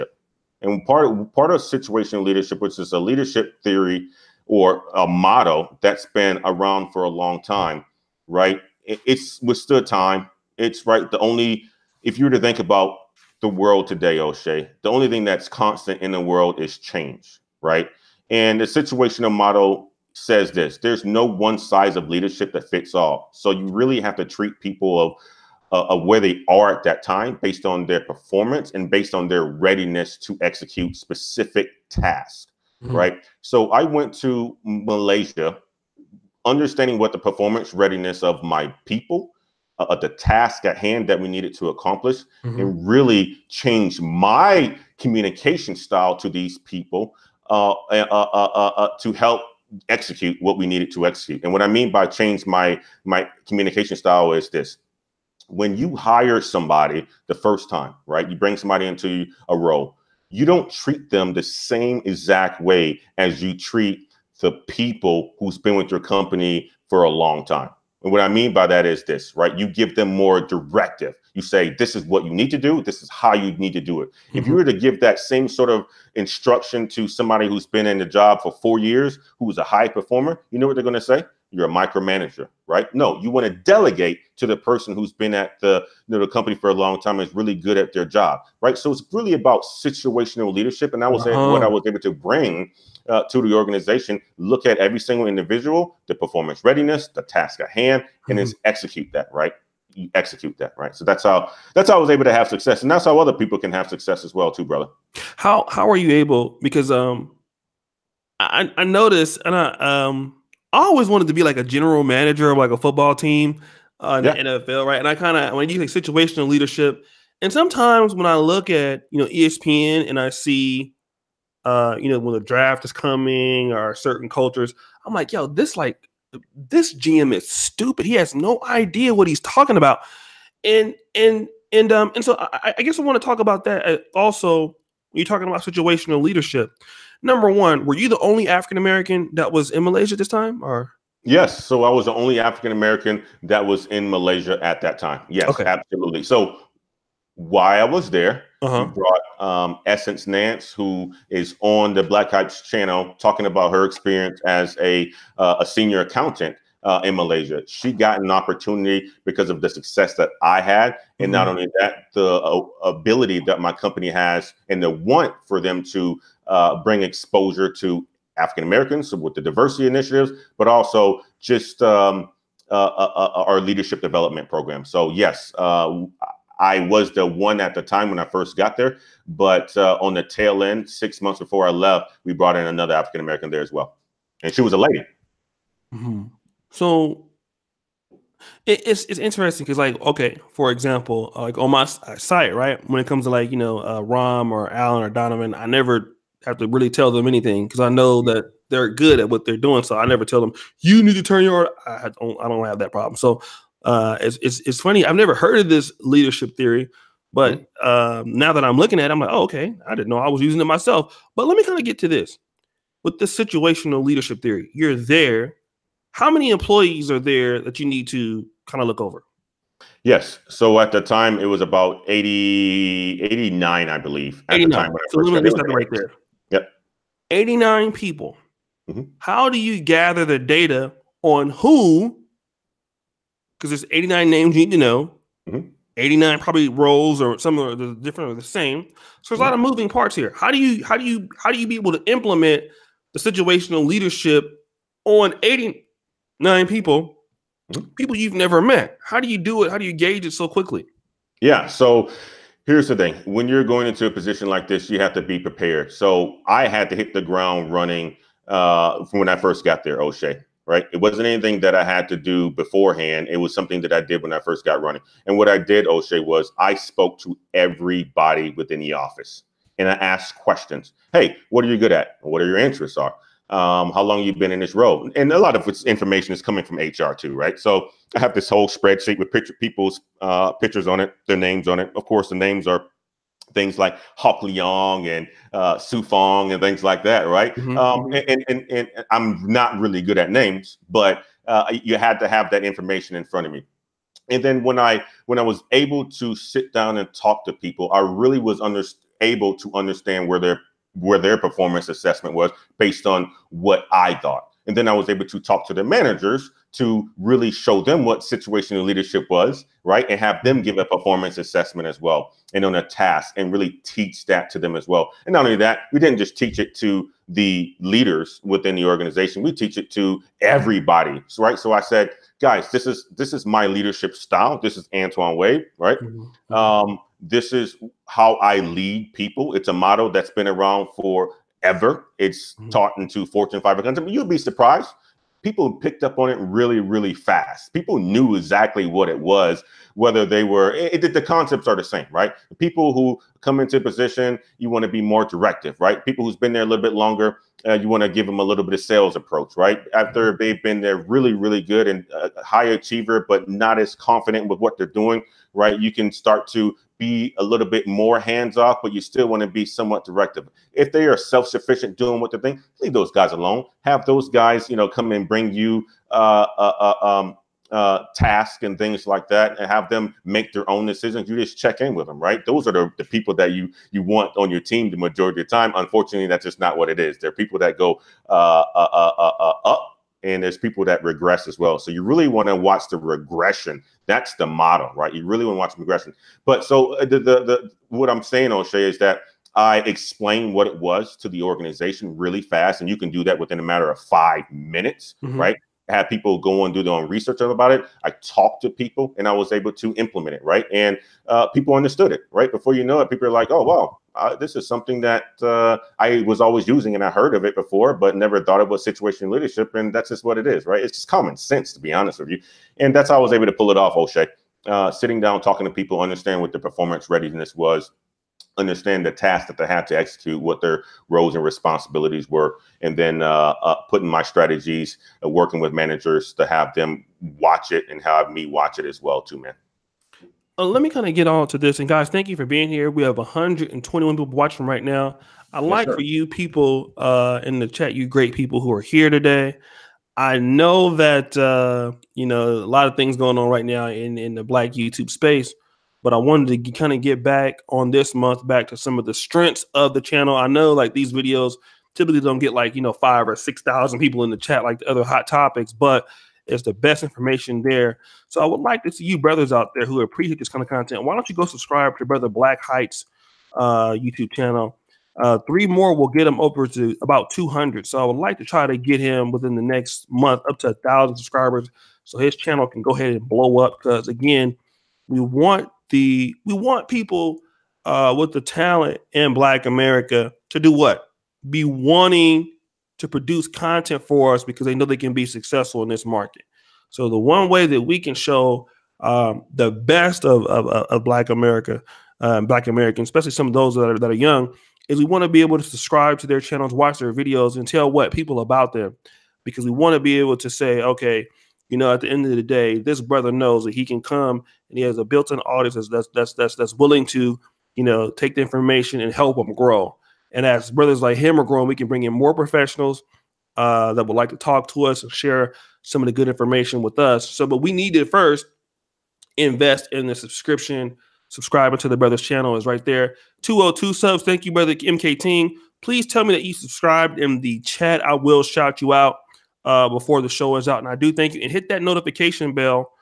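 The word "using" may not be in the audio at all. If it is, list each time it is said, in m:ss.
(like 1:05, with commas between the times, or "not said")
3:30, 6:46.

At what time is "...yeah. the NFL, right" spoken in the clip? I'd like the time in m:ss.
1:54.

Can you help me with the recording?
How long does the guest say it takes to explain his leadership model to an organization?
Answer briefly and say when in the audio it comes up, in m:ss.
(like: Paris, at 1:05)
five minutes, at 6:33.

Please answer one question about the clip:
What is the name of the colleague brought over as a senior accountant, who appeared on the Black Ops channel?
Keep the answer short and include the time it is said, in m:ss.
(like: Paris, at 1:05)
Essence Nance, at 2:29.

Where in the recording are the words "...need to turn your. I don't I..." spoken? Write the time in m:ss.
3:21.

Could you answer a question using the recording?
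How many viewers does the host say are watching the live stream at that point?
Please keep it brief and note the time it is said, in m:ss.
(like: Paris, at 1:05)
121, at 7:13.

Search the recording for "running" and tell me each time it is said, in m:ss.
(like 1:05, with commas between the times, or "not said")
4:17, 4:24.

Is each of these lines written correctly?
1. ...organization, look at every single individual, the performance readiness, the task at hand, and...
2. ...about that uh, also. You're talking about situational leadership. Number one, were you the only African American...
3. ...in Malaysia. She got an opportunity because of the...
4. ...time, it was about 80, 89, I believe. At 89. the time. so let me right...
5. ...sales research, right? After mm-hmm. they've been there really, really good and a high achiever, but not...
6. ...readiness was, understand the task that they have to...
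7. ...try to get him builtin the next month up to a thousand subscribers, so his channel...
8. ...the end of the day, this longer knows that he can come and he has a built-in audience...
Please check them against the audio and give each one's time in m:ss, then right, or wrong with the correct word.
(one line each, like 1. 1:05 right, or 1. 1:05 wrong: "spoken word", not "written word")
1. 1:33 right
2. 2:13 right
3. 2:37 right
4. 3:41 right
5. 5:48 wrong: "approach", not "research"
6. 6:57 right
7. 7:48 wrong: "within", not "builtin"
8. 8:22 wrong: "brother", not "longer".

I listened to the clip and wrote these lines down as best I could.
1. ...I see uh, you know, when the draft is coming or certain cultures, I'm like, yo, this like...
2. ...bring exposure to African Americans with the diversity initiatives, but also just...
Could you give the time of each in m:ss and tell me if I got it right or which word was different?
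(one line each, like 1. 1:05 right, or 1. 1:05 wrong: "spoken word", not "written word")
1. 2:00 right
2. 2:46 right.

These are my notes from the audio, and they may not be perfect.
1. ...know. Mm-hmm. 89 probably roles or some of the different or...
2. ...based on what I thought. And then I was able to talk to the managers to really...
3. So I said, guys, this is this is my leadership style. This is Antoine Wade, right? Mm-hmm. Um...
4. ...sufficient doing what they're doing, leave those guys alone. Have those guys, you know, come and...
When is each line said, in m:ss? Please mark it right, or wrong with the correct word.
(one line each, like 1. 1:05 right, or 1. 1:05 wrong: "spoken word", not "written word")
1. 3:54 right
2. 5:02 right
3. 5:21 right
4. 6:01 right.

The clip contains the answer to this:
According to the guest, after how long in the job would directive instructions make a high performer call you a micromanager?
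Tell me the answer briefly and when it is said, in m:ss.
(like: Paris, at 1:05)
four years, at 1:18.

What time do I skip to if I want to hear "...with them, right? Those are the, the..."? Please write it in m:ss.
6:11.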